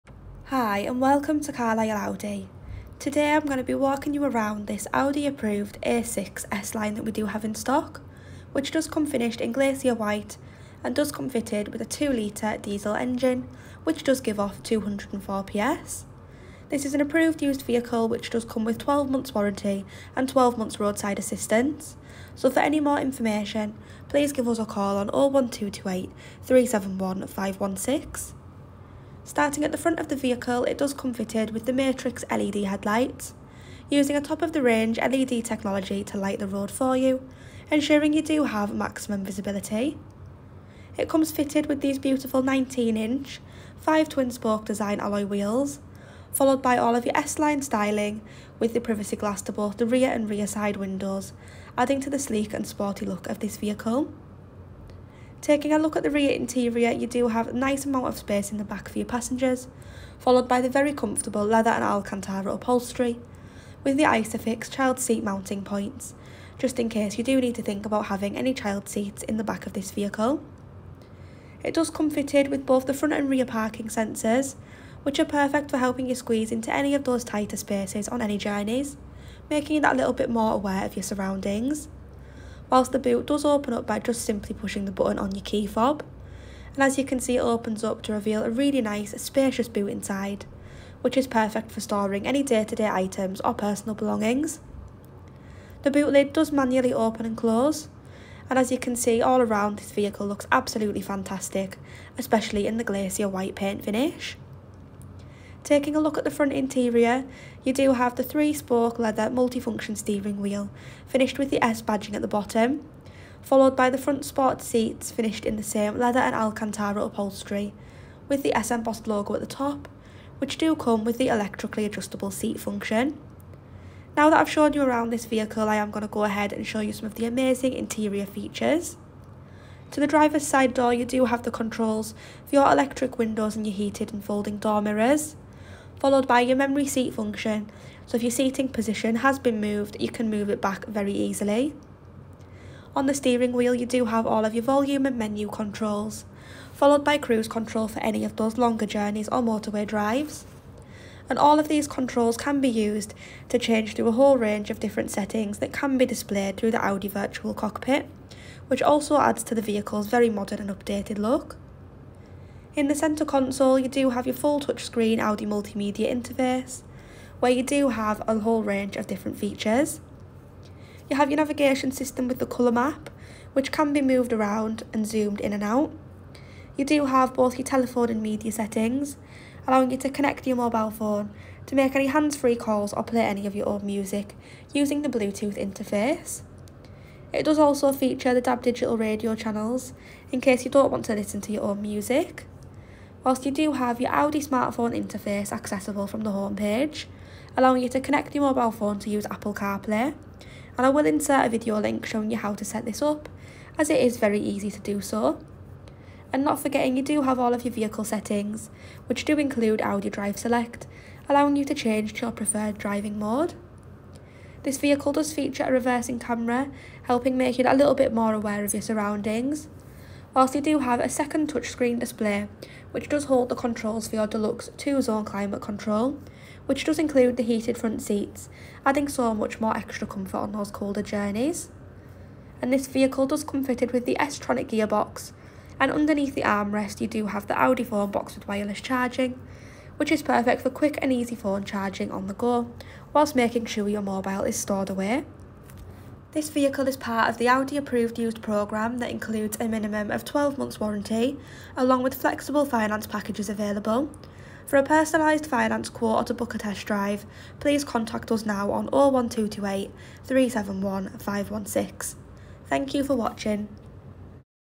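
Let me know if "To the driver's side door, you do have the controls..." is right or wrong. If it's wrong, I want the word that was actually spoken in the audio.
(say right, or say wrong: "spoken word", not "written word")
right.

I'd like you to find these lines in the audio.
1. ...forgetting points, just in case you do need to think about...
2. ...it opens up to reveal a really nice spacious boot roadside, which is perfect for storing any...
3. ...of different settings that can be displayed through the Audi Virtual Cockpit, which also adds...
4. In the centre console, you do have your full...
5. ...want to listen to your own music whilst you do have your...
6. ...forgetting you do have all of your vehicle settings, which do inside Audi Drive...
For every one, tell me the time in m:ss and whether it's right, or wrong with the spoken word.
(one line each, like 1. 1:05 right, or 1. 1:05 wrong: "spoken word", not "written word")
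1. 1:05 wrong: "mounting", not "forgetting"
2. 1:27 wrong: "inside", not "roadside"
3. 2:34 right
4. 2:42 right
5. 3:10 right
6. 3:26 wrong: "include", not "inside".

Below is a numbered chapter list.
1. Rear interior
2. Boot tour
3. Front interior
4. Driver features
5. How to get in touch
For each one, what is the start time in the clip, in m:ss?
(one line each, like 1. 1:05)
1. 0:54
2. 1:22
3. 1:46
4. 2:07
5. 4:05.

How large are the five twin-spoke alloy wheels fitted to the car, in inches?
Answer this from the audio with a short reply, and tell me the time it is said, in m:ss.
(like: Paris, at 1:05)
19-inch, at 0:42.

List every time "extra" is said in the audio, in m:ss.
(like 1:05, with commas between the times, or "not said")
3:49.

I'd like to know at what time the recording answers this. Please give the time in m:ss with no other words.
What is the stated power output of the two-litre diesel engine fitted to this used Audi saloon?
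0:14.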